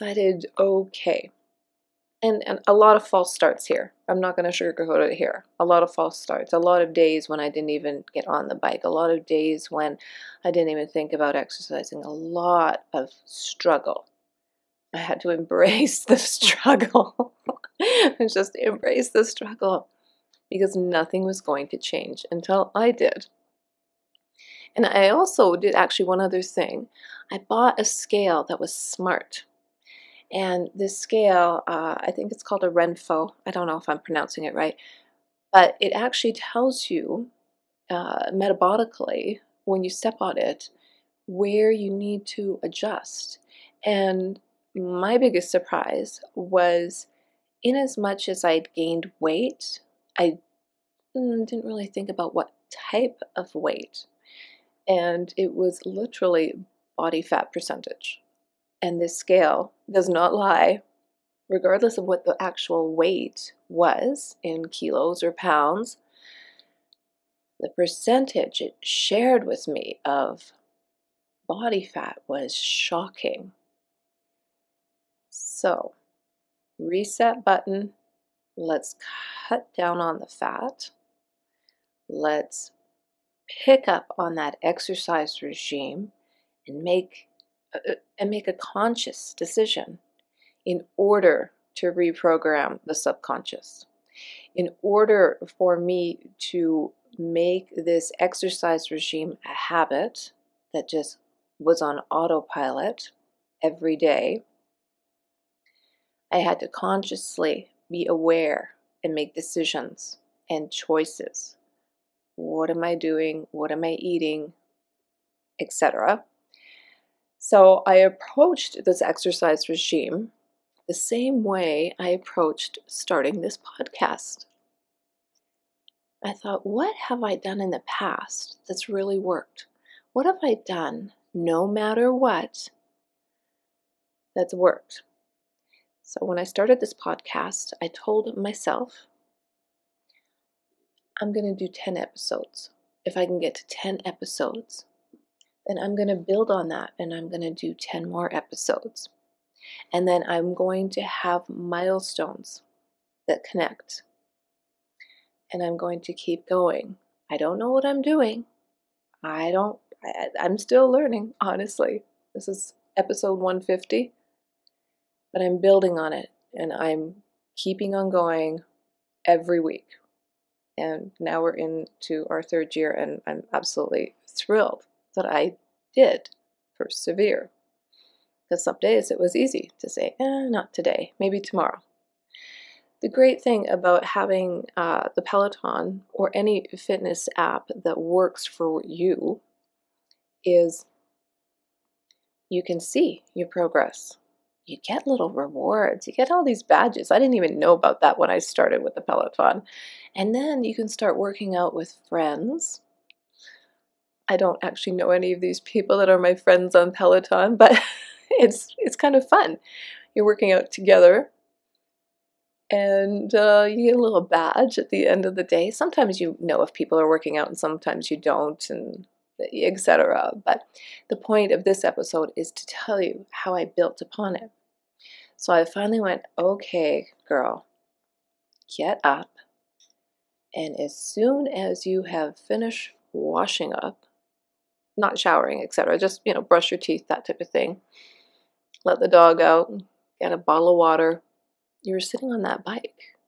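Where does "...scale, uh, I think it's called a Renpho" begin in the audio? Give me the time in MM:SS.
00:30.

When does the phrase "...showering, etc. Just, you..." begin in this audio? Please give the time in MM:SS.
03:55.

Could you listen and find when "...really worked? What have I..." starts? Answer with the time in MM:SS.
02:08.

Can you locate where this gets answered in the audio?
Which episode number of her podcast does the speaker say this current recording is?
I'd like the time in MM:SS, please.
02:42.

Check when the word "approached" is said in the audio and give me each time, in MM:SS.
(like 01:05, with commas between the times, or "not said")
01:57, 02:02.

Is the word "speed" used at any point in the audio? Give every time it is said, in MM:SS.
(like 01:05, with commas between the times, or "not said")
not said.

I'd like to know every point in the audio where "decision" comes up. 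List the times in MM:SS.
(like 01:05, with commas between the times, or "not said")
01:29, 01:49.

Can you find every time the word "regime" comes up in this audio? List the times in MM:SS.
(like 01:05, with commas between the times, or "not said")
01:25, 01:38, 01:59.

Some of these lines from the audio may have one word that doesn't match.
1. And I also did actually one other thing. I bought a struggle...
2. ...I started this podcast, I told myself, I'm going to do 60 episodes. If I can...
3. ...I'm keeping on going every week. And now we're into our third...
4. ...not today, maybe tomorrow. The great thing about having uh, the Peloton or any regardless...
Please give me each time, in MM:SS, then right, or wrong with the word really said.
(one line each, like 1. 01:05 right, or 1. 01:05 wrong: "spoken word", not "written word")
1. 00:24 wrong: "scale", not "struggle"
2. 02:16 wrong: "10", not "60"
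3. 02:46 right
4. 03:00 wrong: "fitness", not "regardless".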